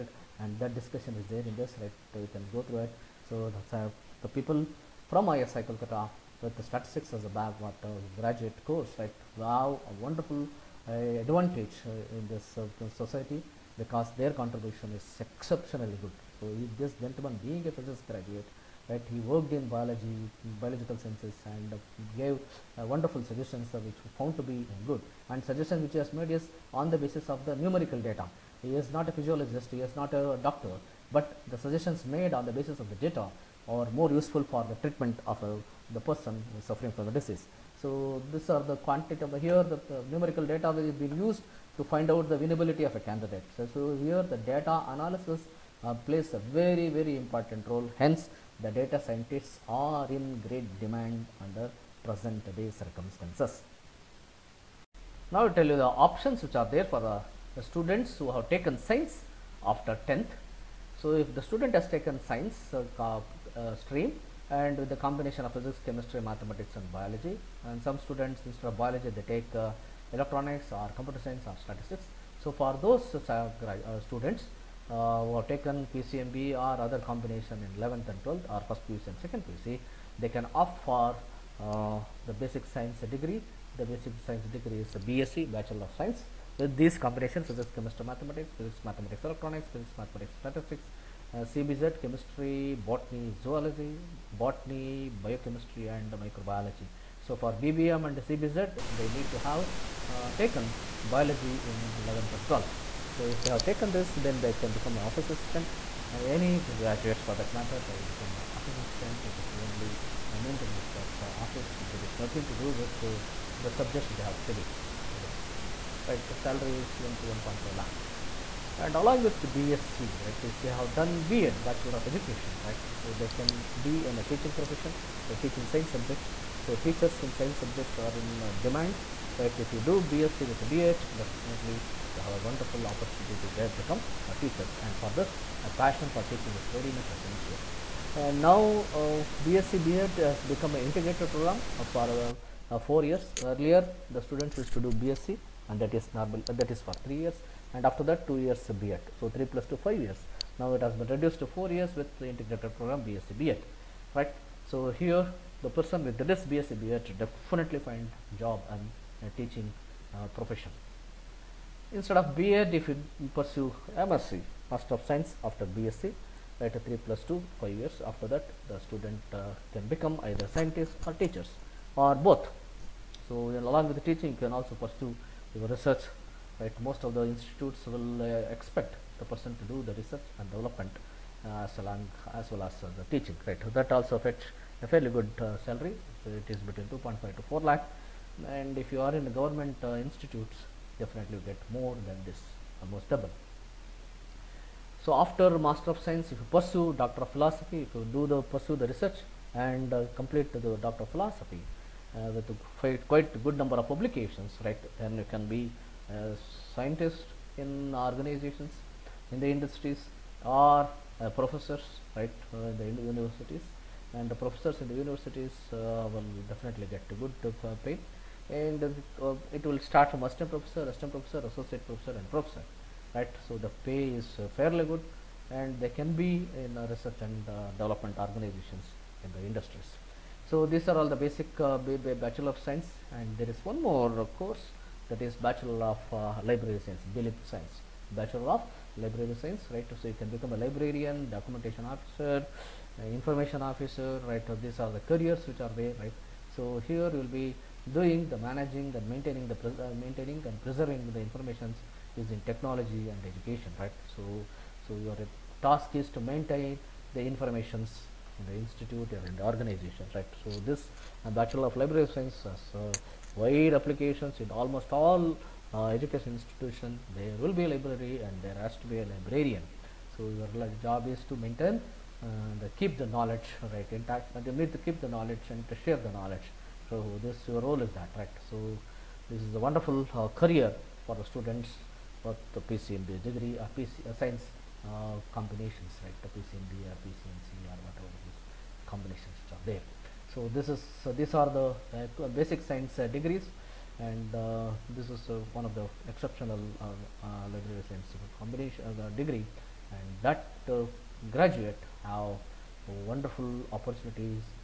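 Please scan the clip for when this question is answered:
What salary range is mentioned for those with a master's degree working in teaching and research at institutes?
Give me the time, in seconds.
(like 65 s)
186 s.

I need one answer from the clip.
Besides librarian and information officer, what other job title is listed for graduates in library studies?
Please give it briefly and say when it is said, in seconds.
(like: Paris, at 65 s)
Documentation officer, at 241 s.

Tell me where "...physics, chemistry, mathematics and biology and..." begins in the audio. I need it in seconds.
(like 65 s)
65 s.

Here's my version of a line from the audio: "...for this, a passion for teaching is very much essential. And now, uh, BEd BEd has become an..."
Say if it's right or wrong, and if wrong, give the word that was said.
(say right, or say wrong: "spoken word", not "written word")
wrong: "BSc", not "BEd".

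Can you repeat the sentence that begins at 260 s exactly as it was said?
So this uh, Bachelor of Library Science.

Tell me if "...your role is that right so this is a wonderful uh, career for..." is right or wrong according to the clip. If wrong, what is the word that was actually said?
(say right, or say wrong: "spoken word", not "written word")
right.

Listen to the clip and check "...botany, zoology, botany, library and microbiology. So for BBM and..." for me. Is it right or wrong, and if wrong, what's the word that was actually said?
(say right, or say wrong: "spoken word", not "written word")
wrong: "biochemistry", not "library".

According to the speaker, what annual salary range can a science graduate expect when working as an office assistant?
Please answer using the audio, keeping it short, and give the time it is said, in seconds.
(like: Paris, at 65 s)
1 to 1.5 lakh, at 116 s.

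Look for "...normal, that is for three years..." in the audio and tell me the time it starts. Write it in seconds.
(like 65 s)
146 s.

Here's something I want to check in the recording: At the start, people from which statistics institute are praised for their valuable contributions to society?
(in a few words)
IIS Kolkata.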